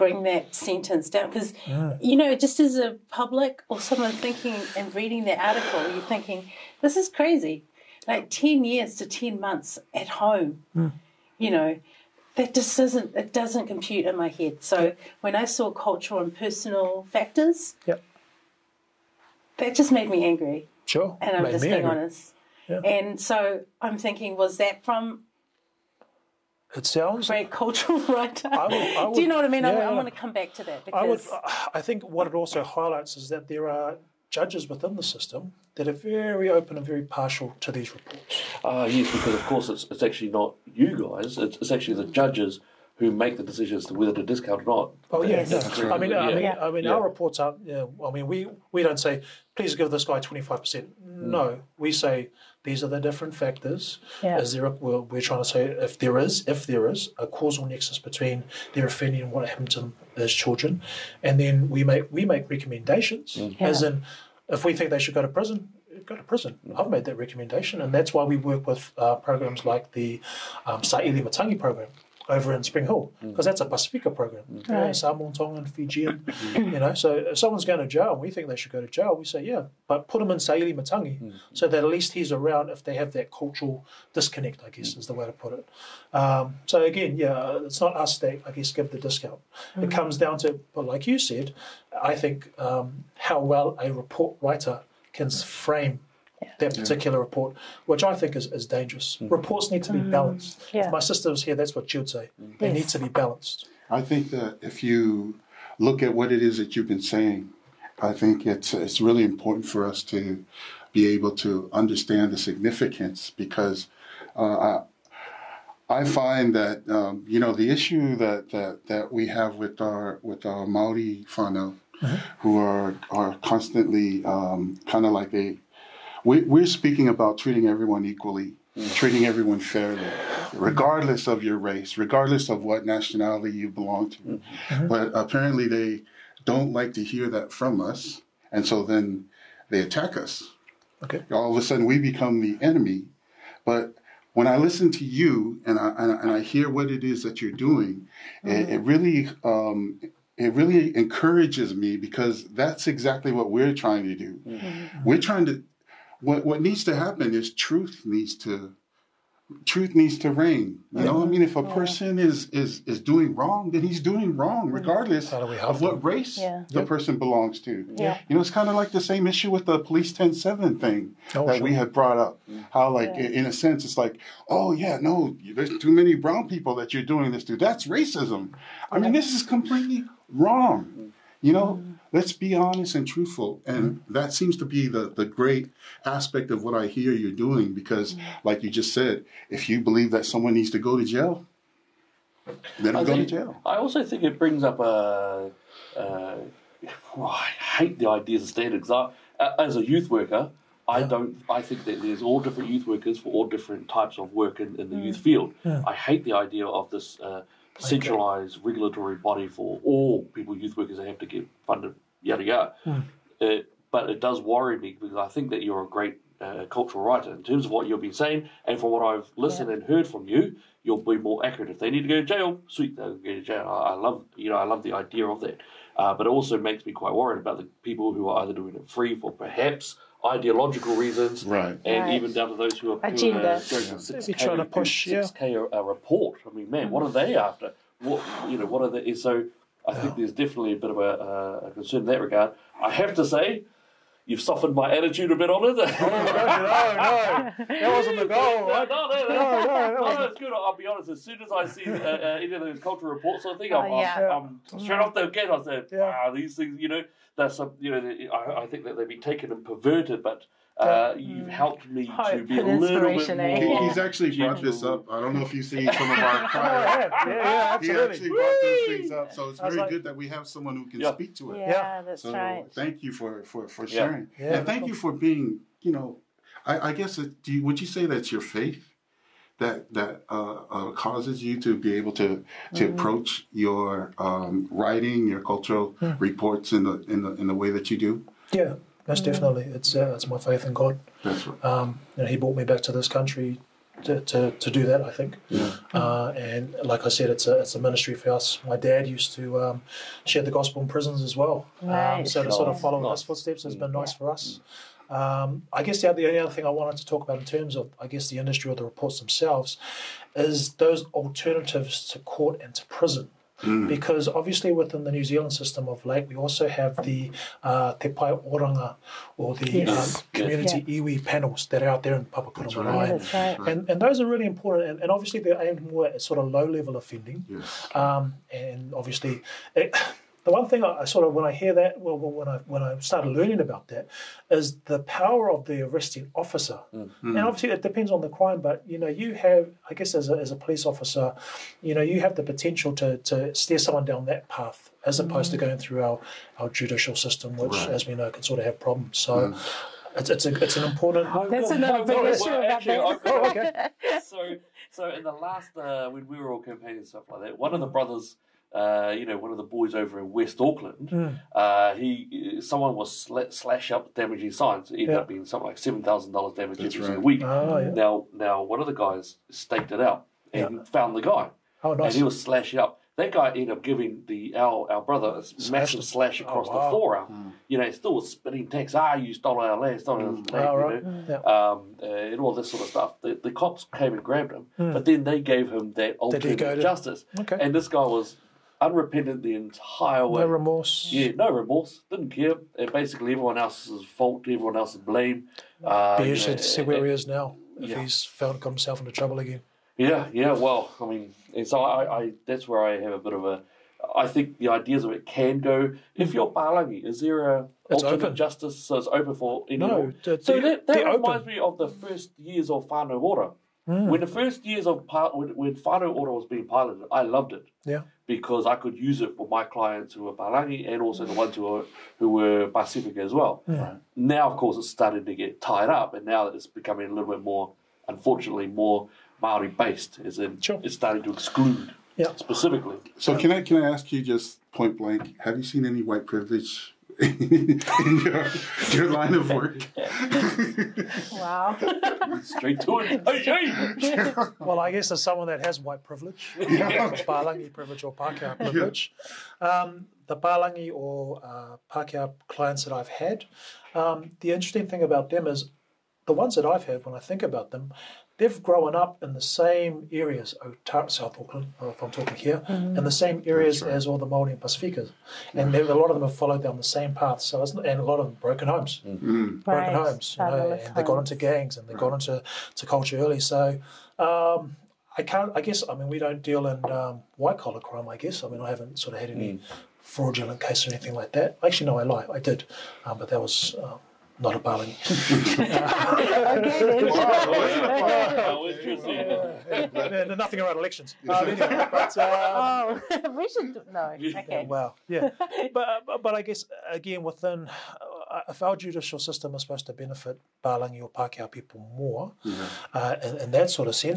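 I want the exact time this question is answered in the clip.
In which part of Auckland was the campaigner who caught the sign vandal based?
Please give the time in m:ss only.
6:00.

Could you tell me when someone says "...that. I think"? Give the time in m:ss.
4:54.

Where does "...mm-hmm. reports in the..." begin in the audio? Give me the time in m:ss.
4:46.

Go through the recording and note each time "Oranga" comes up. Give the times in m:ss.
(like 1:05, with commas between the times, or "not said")
5:18.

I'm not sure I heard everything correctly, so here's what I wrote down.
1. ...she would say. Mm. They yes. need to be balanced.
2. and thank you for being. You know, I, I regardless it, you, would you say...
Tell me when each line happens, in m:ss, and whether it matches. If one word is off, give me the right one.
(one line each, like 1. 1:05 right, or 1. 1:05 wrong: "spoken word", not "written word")
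1. 1:41 right
2. 4:34 wrong: "guess", not "regardless".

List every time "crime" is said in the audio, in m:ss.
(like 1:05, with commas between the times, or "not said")
5:38, 7:57.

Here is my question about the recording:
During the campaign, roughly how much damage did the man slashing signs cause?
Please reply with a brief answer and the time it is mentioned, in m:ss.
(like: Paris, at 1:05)
$7,000, at 6:05.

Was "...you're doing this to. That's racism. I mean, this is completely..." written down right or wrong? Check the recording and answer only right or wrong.
right.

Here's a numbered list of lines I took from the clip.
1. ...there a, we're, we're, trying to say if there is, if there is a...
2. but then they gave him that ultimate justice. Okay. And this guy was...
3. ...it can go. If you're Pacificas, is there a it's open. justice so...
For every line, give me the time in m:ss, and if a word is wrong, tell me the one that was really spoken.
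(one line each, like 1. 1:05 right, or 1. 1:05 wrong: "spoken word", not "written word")
1. 0:54 right
2. 6:24 right
3. 6:45 wrong: "Palangi", not "Pacificas".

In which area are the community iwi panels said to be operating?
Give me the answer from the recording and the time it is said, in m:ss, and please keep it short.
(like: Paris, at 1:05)
Papakura, at 5:22.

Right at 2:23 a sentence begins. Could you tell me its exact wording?
But when I listen to you and I, and I, and I hear what it is that you're doing, mm-hmm.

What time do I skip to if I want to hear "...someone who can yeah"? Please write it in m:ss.
4:30.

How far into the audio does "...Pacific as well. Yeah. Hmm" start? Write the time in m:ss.
7:02.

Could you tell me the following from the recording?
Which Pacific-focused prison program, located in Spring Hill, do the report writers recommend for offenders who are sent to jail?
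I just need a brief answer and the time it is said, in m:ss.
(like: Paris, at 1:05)
Sa'ili Matangi, at 1:10.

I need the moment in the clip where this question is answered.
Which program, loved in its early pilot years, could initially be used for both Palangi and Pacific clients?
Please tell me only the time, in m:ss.
6:52.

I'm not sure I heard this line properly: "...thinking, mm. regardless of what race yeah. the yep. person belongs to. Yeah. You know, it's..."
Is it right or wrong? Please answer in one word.
wrong.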